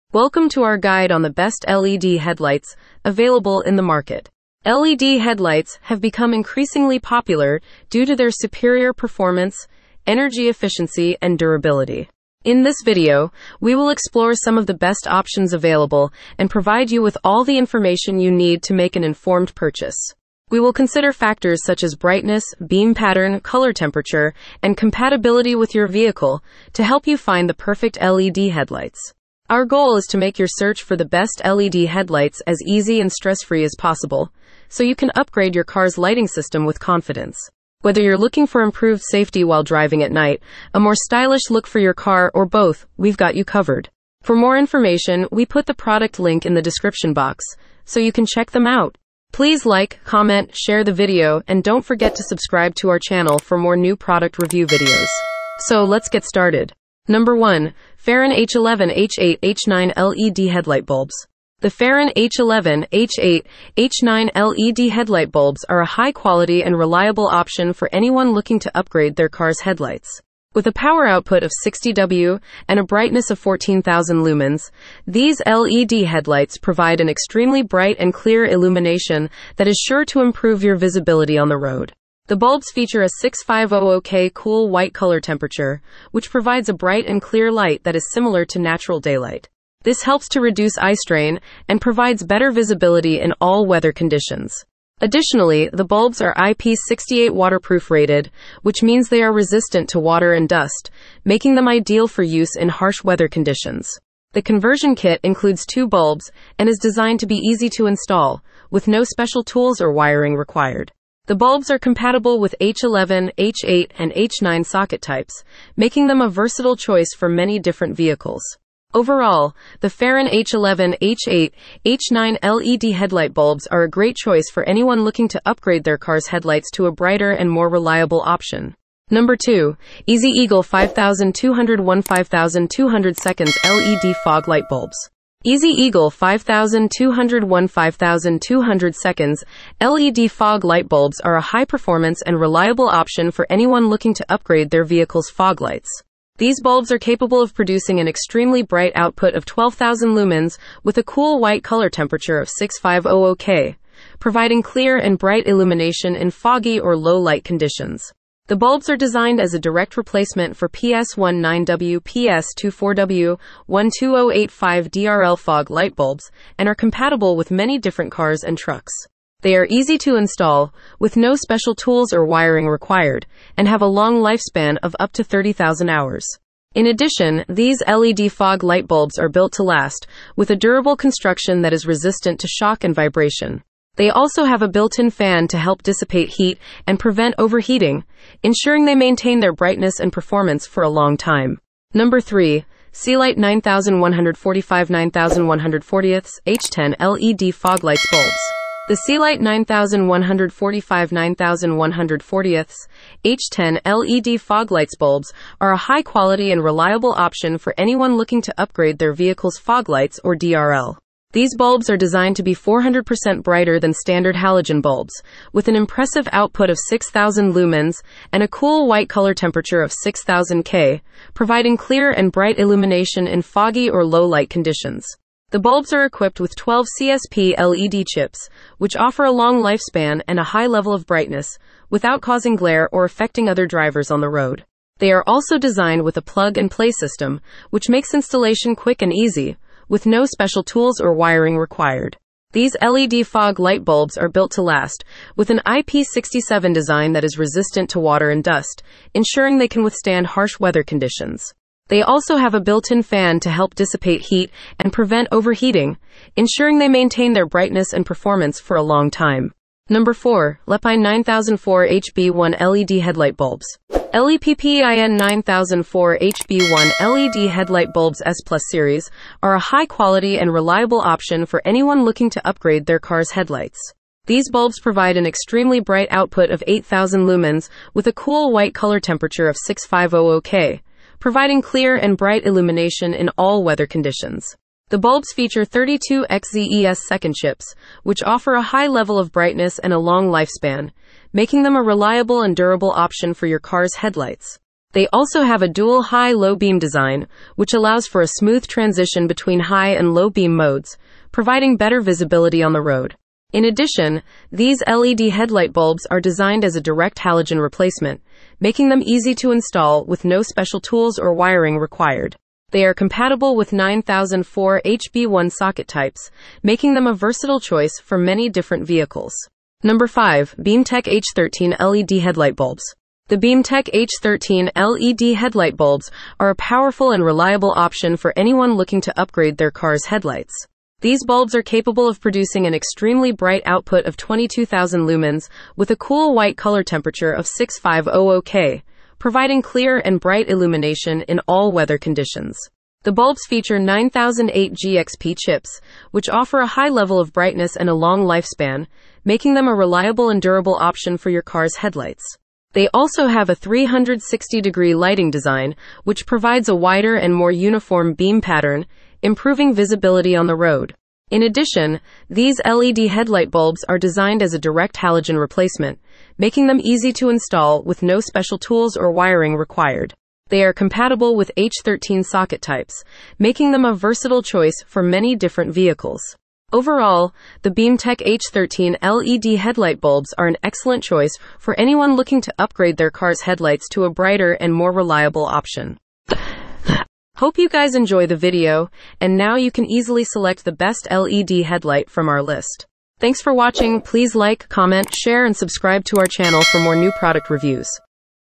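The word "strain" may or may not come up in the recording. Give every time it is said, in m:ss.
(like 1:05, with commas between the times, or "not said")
1:30.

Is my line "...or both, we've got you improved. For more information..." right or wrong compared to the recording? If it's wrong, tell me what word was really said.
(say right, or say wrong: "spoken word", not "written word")
wrong: "covered", not "improved".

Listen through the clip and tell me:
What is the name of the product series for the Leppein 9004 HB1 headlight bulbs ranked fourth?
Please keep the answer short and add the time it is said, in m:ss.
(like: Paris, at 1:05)
S Plus, at 4:28.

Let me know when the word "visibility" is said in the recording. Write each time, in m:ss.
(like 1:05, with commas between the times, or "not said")
1:20, 1:32, 5:02, 5:59.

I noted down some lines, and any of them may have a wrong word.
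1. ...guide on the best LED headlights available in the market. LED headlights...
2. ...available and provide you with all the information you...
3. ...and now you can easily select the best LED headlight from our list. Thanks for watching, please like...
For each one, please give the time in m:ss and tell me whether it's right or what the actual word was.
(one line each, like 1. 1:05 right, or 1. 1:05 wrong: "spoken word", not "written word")
1. 0:00 right
2. 0:15 right
3. 6:29 right.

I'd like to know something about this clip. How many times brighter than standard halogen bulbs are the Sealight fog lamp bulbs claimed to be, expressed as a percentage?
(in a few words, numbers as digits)
400%.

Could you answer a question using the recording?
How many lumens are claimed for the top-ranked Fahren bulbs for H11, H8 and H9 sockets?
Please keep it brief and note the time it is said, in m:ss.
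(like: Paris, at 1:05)
14,000 lumens, at 1:13.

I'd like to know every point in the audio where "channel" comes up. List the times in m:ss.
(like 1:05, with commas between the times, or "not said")
0:52, 6:36.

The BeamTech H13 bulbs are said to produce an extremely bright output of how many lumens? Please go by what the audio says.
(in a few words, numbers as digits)
22,000 lumens.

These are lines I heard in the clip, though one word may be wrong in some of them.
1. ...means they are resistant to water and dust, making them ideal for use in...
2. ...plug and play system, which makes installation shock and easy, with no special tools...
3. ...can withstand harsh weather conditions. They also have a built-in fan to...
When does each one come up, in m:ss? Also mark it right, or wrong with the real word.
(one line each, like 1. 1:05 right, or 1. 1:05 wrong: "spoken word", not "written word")
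1. 1:38 right
2. 3:56 wrong: "quick", not "shock"
3. 4:09 right.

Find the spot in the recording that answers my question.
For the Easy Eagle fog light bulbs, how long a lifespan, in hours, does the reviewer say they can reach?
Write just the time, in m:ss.
2:55.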